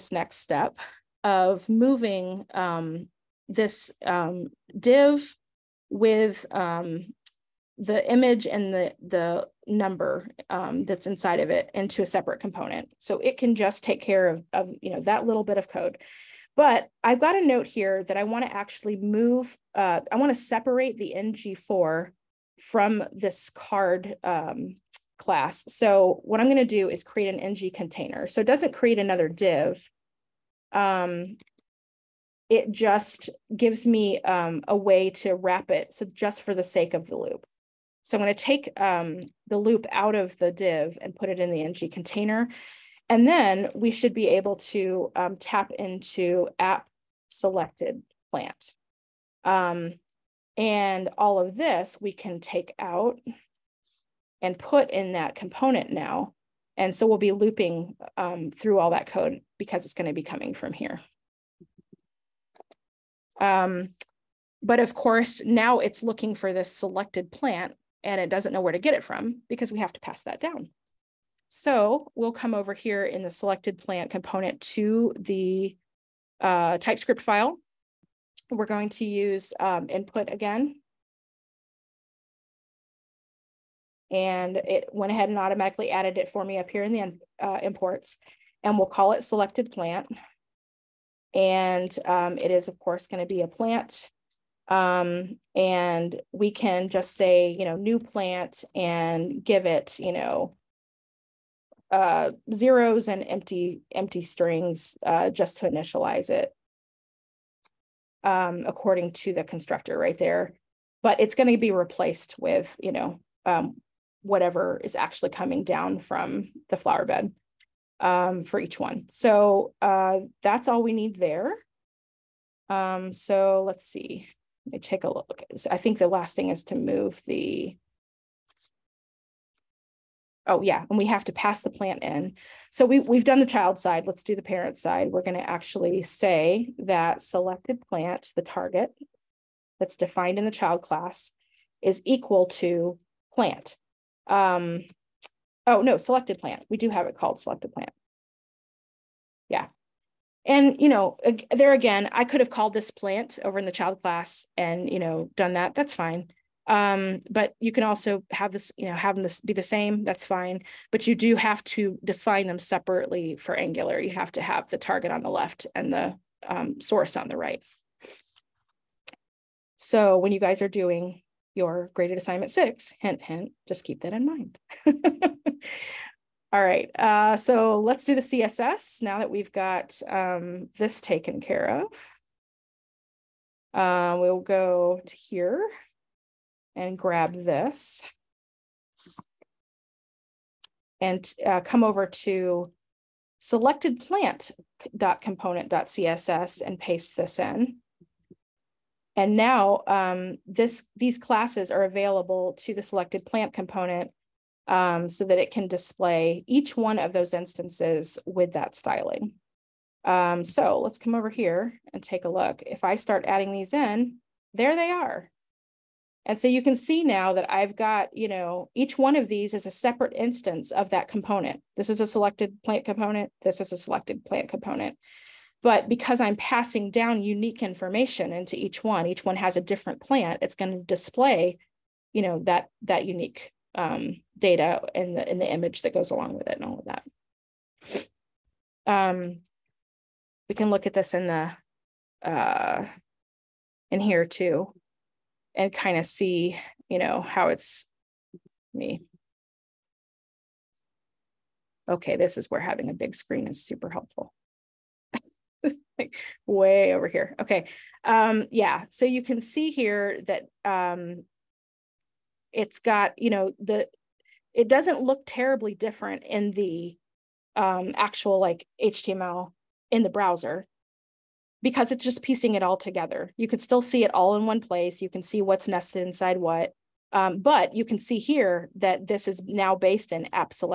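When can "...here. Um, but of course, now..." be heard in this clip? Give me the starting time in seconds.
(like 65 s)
60 s.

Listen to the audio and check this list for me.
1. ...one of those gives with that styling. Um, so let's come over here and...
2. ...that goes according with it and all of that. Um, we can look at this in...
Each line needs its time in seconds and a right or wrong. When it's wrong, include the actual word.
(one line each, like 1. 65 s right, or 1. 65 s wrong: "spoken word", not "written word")
1. 206 s wrong: "instances", not "gives"
2. 235 s wrong: "along", not "according".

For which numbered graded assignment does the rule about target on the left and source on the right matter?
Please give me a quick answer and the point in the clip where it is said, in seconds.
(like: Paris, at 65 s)
6, at 172 s.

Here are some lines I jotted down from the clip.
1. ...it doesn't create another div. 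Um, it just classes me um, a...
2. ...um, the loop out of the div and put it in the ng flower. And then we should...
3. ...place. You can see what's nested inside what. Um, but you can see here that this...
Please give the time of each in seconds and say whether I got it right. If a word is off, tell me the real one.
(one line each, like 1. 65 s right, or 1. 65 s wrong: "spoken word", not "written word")
1. 28 s wrong: "gives", not "classes"
2. 38 s wrong: "container", not "flower"
3. 274 s right.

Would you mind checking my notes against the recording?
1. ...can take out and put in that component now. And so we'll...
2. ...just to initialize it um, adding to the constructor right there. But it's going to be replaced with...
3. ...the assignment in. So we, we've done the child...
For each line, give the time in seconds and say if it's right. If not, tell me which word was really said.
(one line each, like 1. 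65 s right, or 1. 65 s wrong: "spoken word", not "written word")
1. 52 s right
2. 105 s wrong: "according", not "adding"
3. 131 s wrong: "plant", not "assignment".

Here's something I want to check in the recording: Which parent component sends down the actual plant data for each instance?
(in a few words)
flower bed.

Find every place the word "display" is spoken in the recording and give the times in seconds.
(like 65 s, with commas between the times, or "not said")
205 s, 230 s.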